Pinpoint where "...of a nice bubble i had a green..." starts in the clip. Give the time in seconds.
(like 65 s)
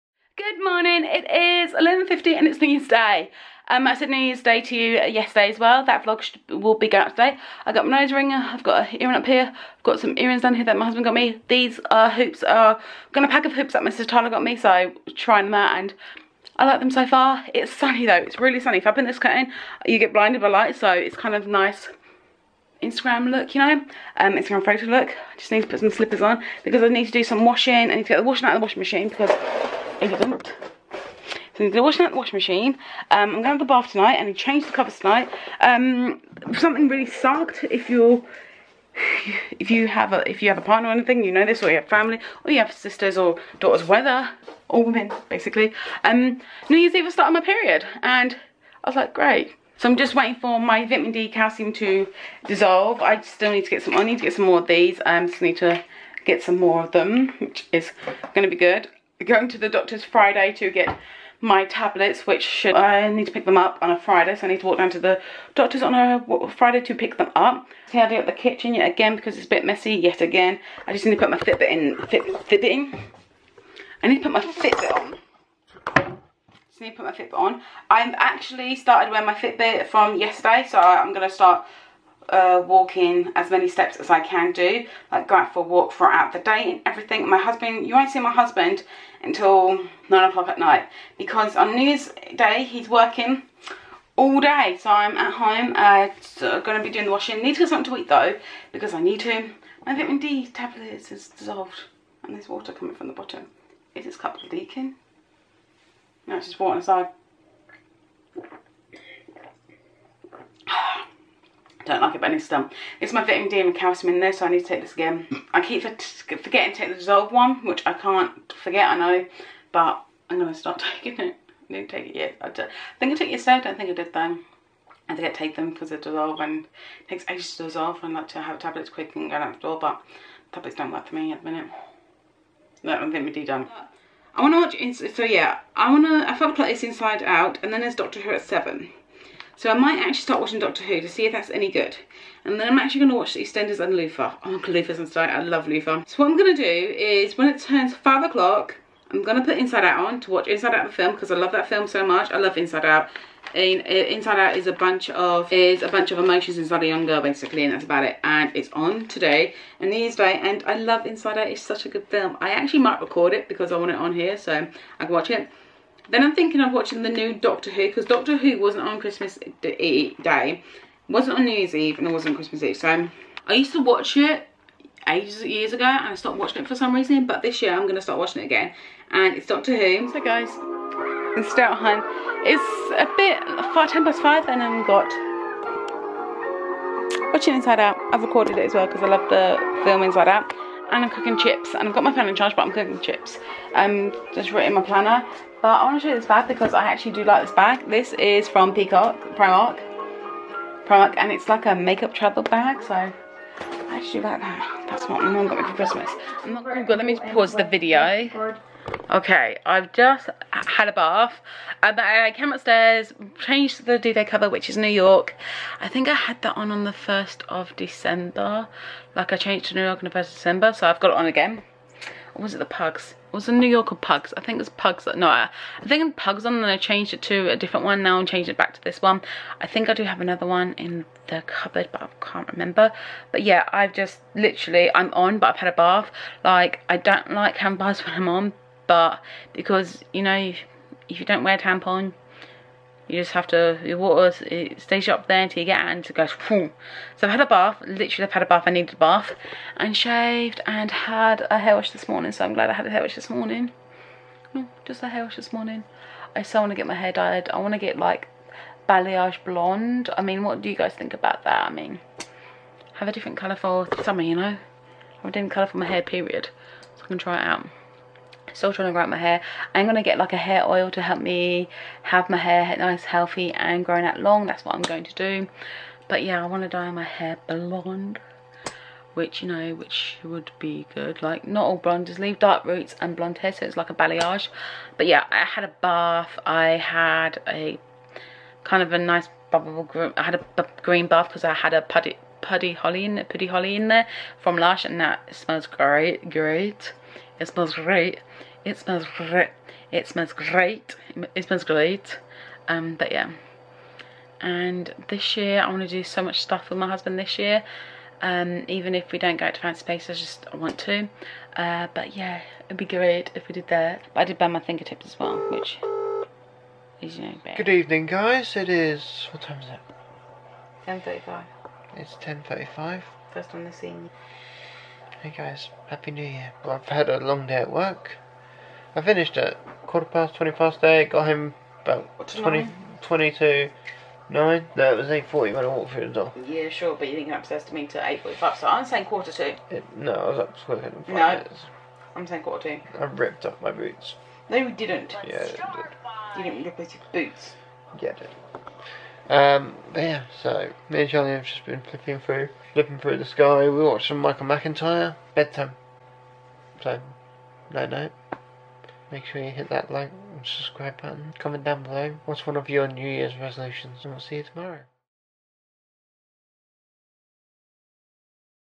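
288 s.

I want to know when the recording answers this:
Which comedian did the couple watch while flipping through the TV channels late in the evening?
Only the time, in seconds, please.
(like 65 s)
354 s.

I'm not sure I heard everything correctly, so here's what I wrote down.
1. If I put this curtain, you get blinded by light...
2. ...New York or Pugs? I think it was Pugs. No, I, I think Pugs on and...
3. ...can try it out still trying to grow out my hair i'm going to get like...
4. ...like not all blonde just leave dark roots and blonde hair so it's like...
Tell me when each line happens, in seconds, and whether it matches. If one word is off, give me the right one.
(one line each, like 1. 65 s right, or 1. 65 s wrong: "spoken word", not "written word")
1. 18 s right
2. 223 s right
3. 267 s right
4. 281 s right.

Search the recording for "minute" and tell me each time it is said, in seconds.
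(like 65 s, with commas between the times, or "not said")
131 s, 341 s.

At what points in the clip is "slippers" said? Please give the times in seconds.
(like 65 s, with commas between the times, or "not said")
25 s.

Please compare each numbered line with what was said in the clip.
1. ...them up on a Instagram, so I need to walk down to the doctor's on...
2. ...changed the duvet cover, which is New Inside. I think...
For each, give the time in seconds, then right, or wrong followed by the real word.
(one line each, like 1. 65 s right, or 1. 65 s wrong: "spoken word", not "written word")
1. 63 s wrong: "Friday", not "Instagram"
2. 213 s wrong: "York", not "Inside".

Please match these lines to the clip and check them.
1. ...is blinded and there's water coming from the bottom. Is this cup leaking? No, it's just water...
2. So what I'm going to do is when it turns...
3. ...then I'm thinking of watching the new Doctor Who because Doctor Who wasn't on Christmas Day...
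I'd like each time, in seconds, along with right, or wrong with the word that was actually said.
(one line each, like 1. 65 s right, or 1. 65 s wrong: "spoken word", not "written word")
1. 101 s wrong: "dissolved", not "blinded"
2. 146 s right
3. 166 s right.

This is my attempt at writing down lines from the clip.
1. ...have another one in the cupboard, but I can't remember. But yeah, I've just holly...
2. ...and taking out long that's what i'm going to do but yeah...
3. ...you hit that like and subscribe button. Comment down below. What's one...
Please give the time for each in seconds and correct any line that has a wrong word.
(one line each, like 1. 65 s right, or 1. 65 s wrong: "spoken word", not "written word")
1. 230 s wrong: "literally", not "holly"
2. 273 s wrong: "growing", not "taking"
3. 359 s right.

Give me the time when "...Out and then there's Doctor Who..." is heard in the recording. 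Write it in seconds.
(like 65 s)
137 s.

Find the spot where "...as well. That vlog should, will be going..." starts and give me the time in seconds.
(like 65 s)
5 s.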